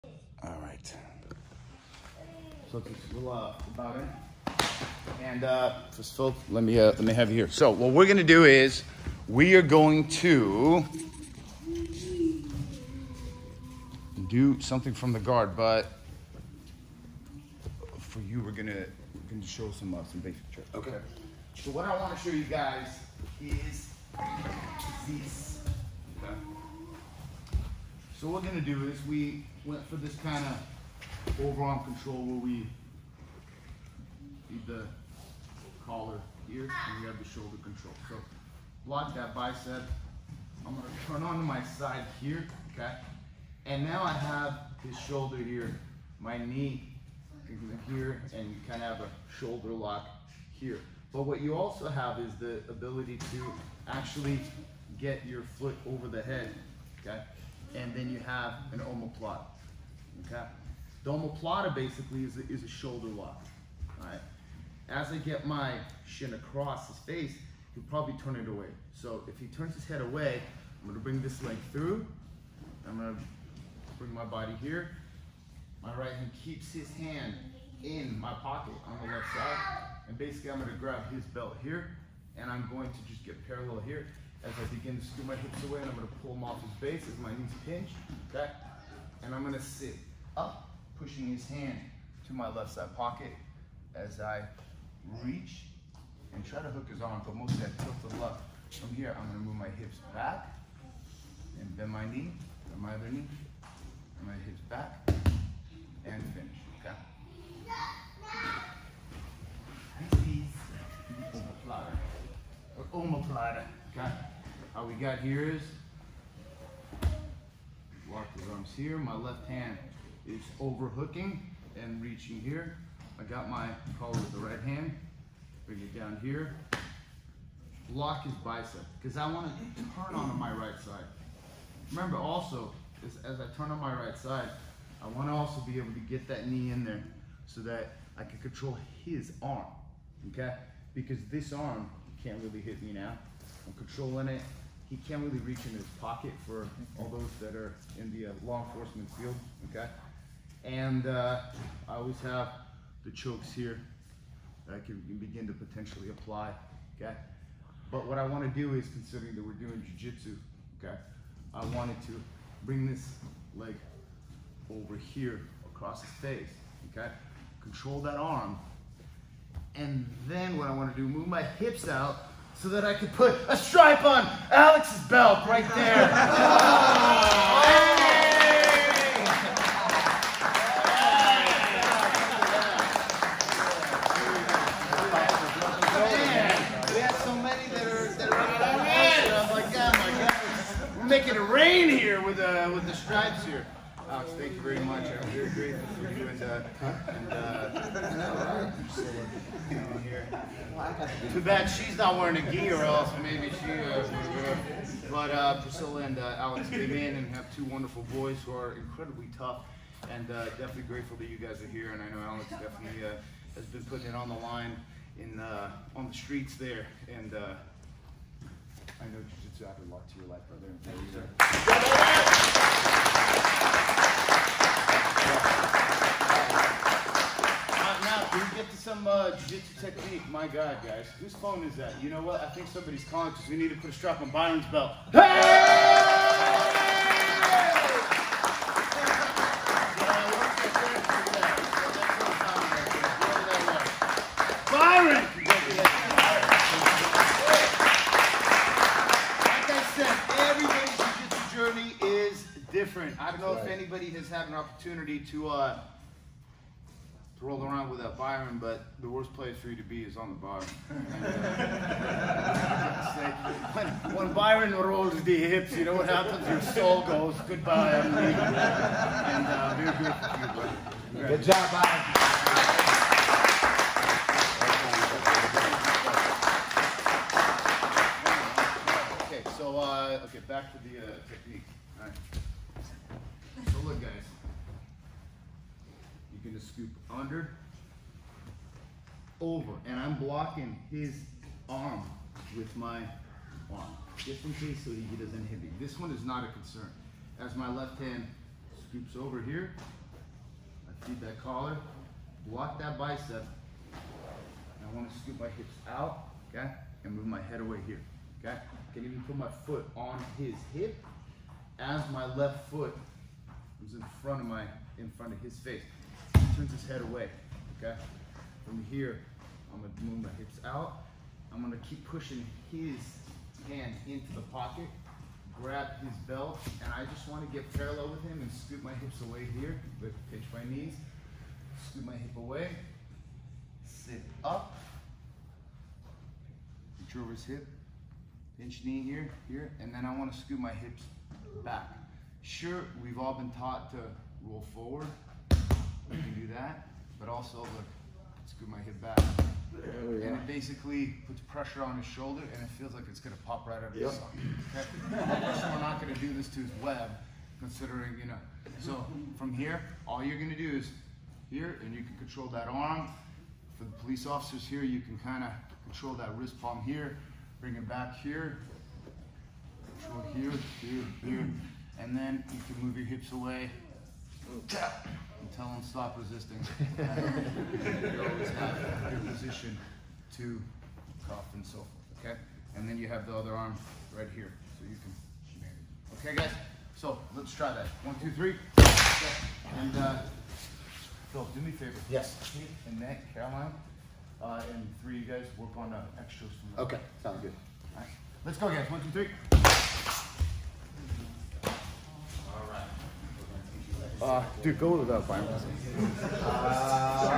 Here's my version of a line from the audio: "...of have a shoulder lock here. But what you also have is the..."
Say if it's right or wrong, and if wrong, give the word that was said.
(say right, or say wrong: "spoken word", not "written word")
right.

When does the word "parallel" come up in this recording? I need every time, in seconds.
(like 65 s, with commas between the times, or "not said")
83 s, 327 s.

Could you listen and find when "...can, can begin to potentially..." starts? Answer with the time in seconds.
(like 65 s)
154 s.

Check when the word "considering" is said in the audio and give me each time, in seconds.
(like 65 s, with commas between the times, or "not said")
158 s, 357 s.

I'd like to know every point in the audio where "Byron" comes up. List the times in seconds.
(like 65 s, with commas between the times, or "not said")
234 s, 244 s, 258 s, 264 s, 271 s.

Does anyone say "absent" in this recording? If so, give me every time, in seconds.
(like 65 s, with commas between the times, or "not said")
not said.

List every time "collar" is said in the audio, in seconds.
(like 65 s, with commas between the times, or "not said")
35 s, 123 s, 301 s.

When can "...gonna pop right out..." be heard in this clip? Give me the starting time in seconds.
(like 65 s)
353 s.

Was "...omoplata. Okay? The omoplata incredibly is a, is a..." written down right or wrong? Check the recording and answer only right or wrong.
wrong.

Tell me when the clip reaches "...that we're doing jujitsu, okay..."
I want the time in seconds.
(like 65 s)
159 s.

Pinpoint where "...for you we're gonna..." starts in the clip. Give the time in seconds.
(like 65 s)
17 s.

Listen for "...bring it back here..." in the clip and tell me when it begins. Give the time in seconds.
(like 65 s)
367 s.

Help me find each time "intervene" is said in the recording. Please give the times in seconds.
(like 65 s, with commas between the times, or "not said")
not said.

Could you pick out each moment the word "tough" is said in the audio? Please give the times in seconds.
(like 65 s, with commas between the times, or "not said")
209 s.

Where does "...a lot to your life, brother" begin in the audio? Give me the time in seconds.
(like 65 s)
219 s.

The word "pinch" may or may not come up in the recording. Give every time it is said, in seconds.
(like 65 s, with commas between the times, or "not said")
87 s, 330 s, 338 s.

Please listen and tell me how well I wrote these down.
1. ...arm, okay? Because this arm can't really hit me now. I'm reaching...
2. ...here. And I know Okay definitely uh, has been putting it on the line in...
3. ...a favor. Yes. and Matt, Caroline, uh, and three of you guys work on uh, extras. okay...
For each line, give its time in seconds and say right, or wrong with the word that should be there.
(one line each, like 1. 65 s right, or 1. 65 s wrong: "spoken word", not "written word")
1. 139 s wrong: "controlling", not "reaching"
2. 211 s wrong: "Alex", not "Okay"
3. 391 s right.